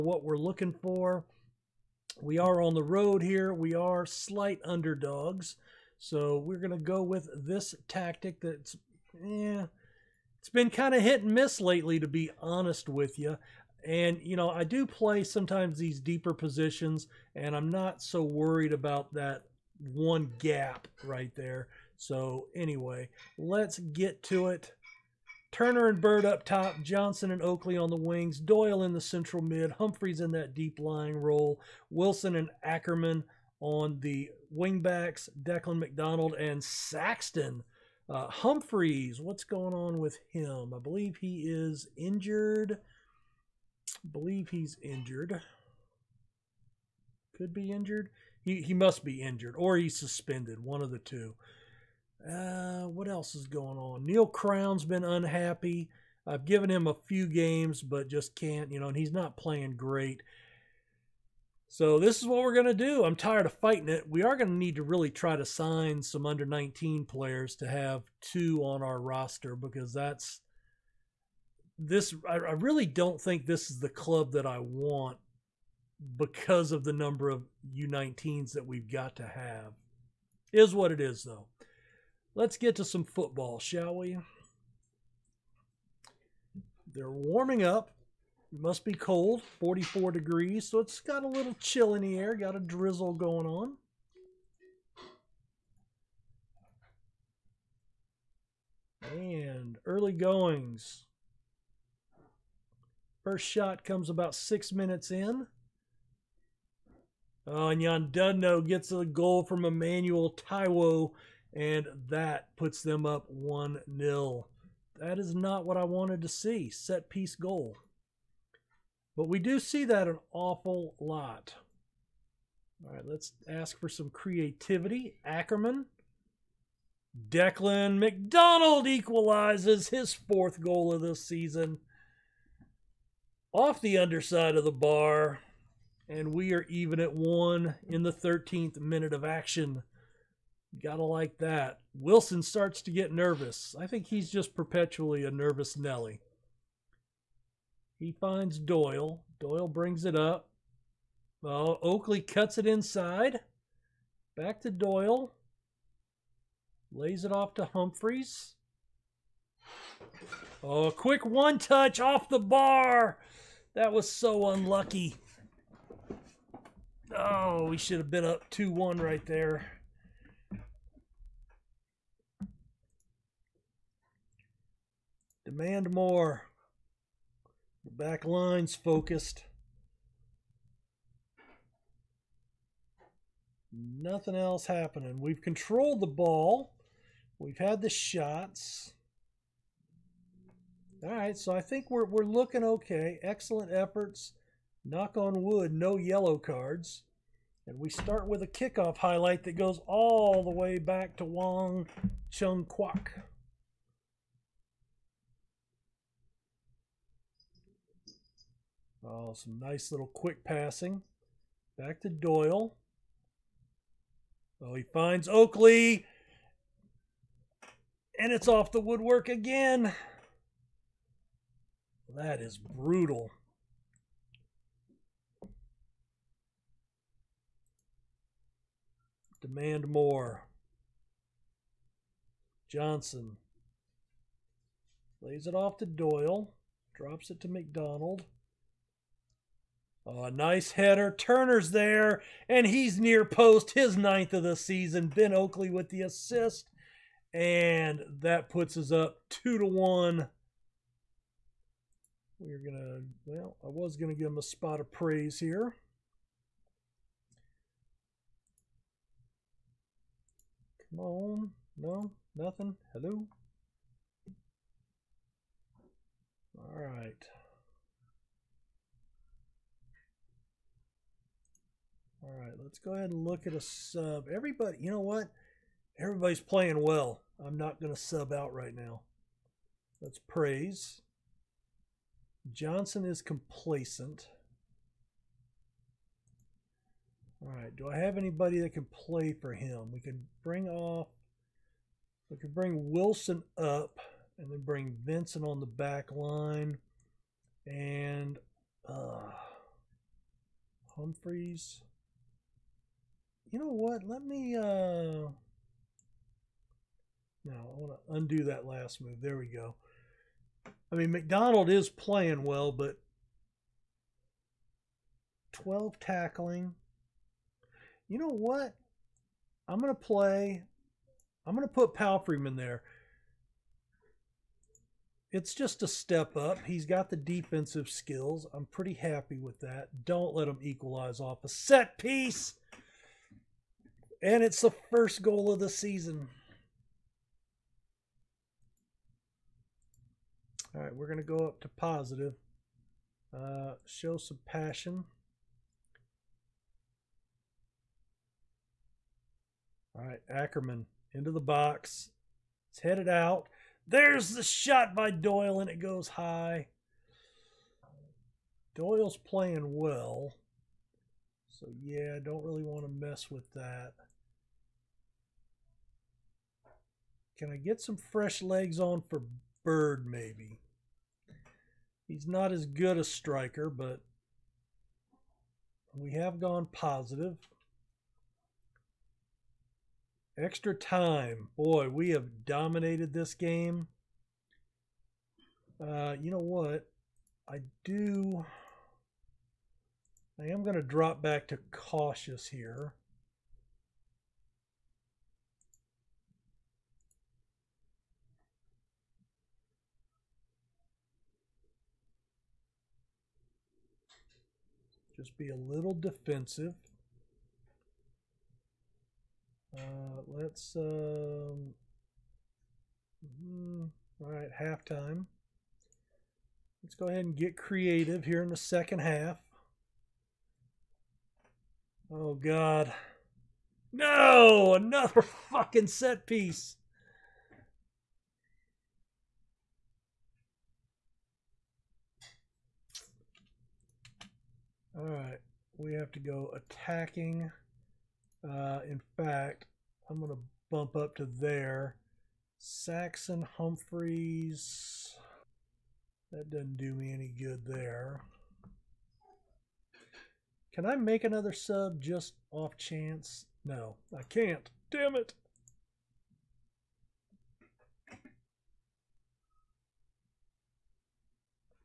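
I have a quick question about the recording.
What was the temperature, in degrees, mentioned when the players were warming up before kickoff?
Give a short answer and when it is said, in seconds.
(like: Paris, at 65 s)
44, at 89 s.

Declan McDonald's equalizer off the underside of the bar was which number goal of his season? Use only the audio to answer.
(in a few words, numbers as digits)
4th.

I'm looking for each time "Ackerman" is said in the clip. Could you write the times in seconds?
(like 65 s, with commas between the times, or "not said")
32 s, 125 s, 350 s.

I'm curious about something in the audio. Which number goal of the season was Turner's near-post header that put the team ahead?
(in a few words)
9th.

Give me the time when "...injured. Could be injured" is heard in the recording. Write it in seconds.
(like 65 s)
44 s.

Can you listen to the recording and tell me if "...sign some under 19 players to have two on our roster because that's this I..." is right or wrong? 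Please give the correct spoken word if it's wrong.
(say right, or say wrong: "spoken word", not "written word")
right.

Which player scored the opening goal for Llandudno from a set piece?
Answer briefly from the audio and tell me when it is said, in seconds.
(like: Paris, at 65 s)
Emmanuel Taiwo, at 109 s.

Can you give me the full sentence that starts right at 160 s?
Oh, quick one touch off the bar.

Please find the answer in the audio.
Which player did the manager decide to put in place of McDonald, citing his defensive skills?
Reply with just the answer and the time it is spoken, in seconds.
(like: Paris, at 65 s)
Palfreyman, at 321 s.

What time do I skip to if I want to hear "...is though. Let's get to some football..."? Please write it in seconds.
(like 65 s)
80 s.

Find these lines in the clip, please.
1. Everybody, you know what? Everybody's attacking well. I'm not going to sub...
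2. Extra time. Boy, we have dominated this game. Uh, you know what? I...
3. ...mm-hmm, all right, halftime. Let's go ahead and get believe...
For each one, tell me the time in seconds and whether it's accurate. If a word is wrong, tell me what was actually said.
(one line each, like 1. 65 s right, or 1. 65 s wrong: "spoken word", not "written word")
1. 274 s wrong: "playing", not "attacking"
2. 380 s right
3. 413 s wrong: "creative", not "believe".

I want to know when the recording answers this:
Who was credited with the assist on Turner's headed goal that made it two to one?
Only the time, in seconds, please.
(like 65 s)
245 s.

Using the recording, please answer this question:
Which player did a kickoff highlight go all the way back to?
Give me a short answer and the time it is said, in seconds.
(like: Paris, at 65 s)
Wong Chung Kwok, at 201 s.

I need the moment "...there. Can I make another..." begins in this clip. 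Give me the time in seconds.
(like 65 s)
447 s.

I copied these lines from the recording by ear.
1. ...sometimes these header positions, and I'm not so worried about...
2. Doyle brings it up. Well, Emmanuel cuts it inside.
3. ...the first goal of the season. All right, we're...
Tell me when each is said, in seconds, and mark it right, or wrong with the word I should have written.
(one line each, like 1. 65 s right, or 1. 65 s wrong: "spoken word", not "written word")
1. 15 s wrong: "deeper", not "header"
2. 149 s wrong: "Oakley", not "Emmanuel"
3. 334 s right.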